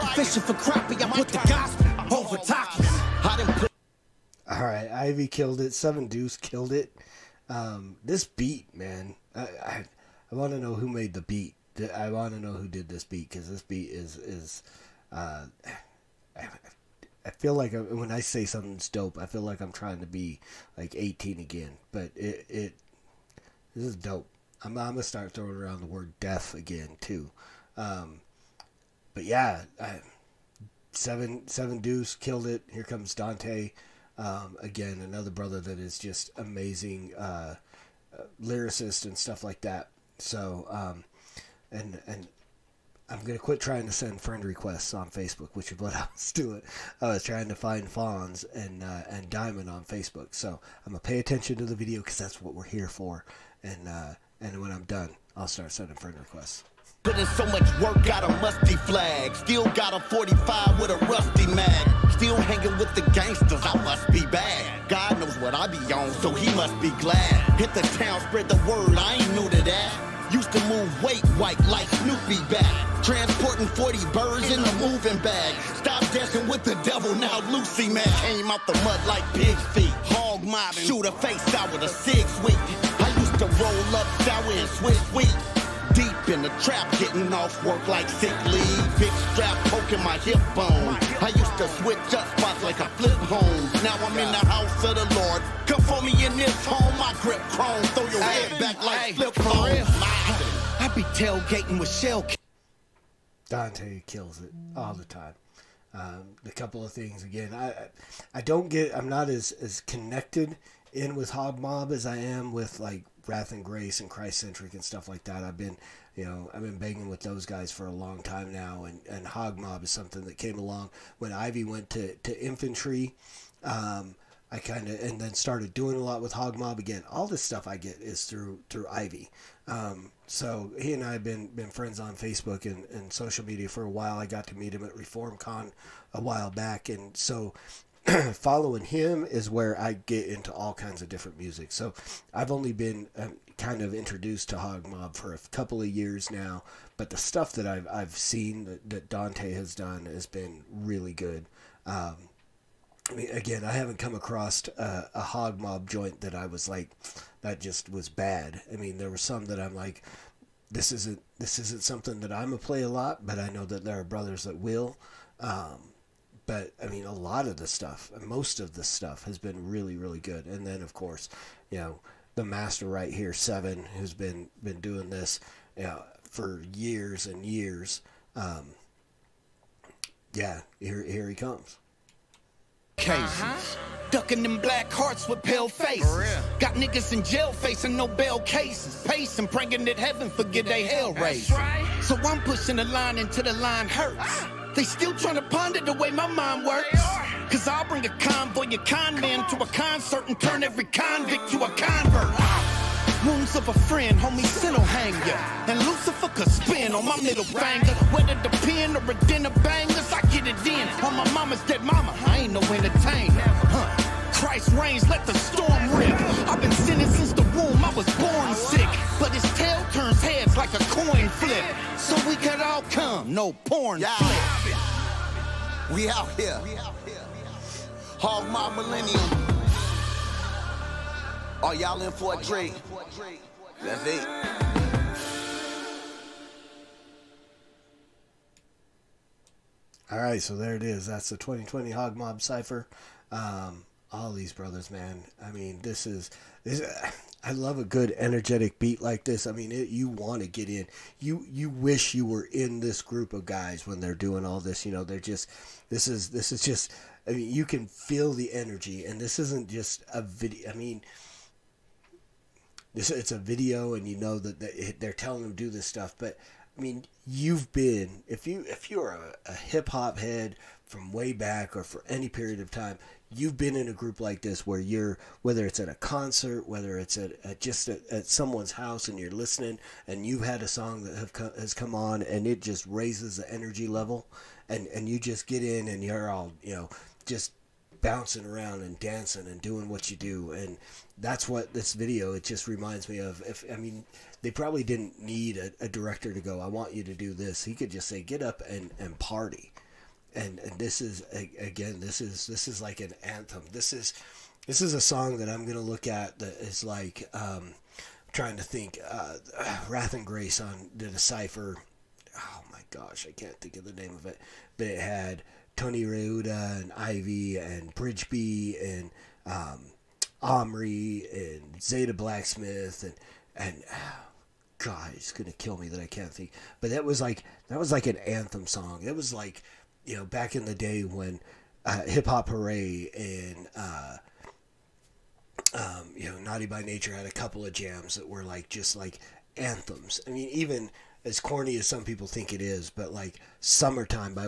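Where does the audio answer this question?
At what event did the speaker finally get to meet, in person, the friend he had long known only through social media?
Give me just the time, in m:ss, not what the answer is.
2:14.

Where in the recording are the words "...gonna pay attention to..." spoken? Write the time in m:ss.
0:50.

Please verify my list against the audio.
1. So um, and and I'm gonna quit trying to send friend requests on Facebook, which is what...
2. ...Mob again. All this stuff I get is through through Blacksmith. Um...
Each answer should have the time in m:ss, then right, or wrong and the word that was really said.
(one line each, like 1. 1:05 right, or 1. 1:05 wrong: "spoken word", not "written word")
1. 0:40 right
2. 2:06 wrong: "Ivy", not "Blacksmith".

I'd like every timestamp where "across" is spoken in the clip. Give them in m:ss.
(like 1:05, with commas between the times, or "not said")
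2:34.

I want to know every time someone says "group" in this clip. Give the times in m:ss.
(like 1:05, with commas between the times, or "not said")
4:13, 4:33.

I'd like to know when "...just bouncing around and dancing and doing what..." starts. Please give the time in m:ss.
4:47.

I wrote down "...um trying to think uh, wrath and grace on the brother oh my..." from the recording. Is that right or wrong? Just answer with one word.
wrong.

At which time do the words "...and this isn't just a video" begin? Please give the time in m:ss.
4:19.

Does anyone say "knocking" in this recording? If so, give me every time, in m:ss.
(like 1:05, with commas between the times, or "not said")
not said.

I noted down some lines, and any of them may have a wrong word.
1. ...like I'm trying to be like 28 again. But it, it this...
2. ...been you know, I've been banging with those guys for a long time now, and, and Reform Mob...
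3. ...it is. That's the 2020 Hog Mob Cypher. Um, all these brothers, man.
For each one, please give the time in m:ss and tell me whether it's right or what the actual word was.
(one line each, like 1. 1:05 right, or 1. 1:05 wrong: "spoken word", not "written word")
1. 0:19 wrong: "18", not "28"
2. 1:55 wrong: "Hog", not "Reform"
3. 4:00 right.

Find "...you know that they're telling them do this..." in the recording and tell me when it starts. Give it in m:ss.
4:24.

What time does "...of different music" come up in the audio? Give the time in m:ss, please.
2:21.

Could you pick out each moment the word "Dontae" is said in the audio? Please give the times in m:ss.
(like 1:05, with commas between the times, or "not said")
0:33, 1:43, 2:29.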